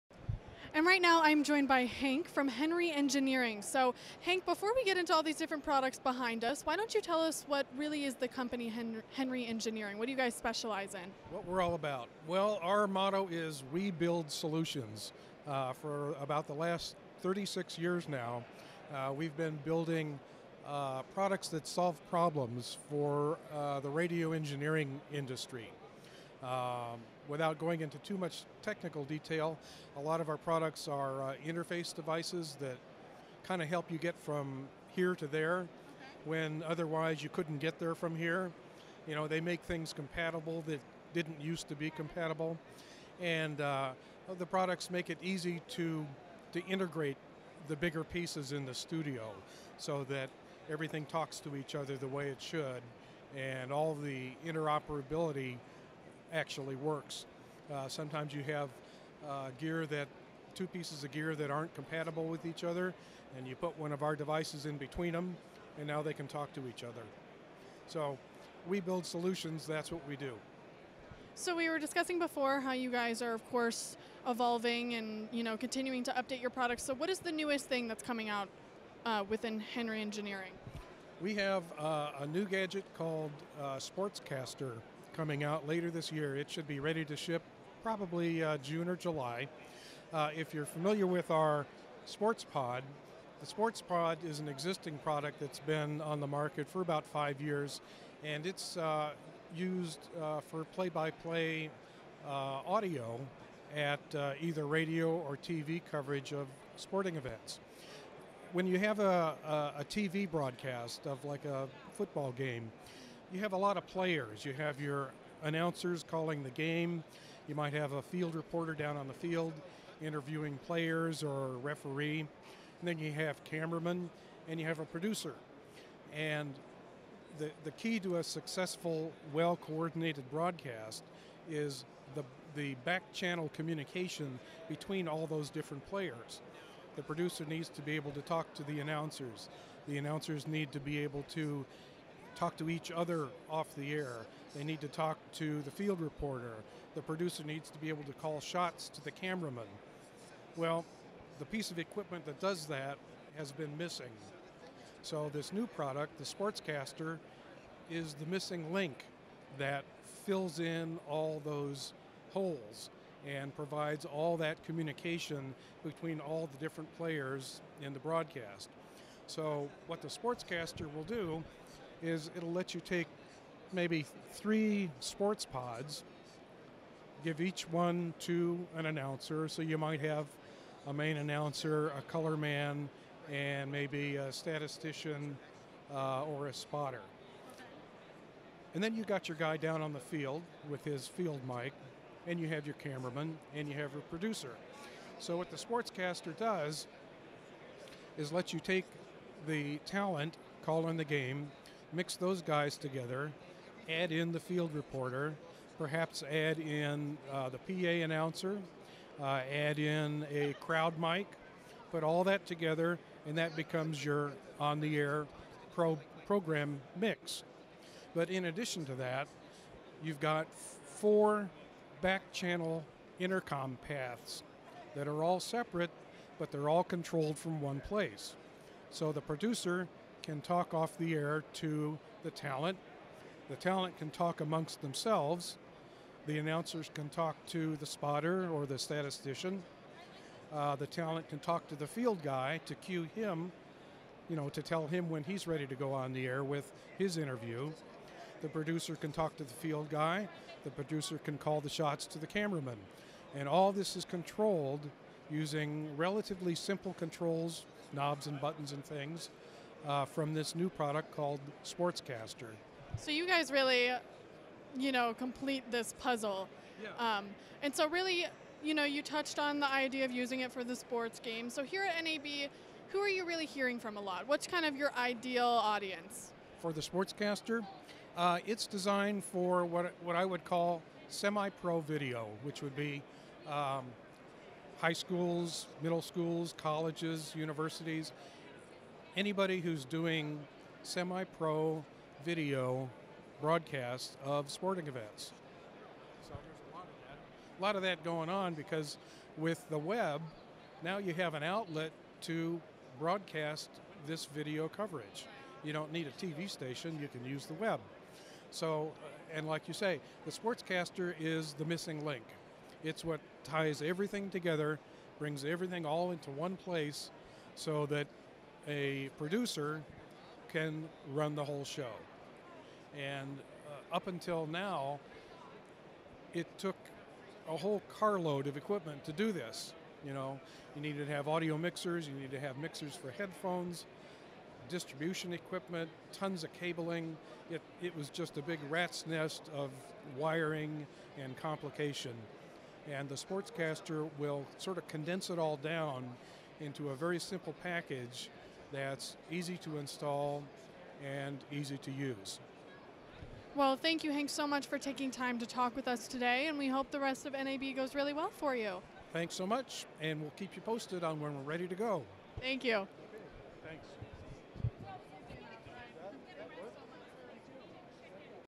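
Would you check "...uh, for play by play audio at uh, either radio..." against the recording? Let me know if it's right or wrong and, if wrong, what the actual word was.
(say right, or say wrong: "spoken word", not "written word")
right.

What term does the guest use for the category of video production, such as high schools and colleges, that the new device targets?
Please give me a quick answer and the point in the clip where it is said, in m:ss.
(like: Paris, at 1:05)
semi-pro video, at 4:41.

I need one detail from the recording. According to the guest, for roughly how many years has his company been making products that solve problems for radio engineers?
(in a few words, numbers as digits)
36 years.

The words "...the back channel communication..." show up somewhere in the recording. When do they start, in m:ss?
2:12.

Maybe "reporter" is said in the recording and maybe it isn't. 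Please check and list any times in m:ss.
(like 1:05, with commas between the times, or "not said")
1:58, 2:26, 3:24.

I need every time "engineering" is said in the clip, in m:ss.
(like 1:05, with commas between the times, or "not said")
0:02, 0:09, 0:24, 1:20.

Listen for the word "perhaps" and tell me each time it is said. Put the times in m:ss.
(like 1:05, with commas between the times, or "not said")
3:25.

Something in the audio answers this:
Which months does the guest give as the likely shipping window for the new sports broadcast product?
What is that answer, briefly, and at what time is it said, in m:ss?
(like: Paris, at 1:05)
June or July, at 1:28.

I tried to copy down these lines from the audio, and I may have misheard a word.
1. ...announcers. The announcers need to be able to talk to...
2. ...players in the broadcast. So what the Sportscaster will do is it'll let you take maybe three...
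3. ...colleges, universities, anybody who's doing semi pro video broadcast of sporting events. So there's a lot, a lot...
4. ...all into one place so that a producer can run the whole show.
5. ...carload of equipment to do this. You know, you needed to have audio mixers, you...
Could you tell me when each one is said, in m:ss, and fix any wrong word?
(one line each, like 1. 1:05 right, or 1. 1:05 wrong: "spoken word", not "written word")
1. 2:18 right
2. 2:46 right
3. 4:46 right
4. 5:15 right
5. 5:27 right.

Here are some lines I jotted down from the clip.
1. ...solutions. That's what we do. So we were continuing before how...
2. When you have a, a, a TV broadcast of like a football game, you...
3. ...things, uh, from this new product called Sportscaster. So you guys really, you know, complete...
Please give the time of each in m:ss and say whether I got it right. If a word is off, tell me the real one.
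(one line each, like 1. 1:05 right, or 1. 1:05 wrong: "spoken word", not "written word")
1. 1:09 wrong: "discussing", not "continuing"
2. 1:48 right
3. 4:18 right.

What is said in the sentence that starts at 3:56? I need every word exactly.
The announcers can talk to the spotter or the statistician.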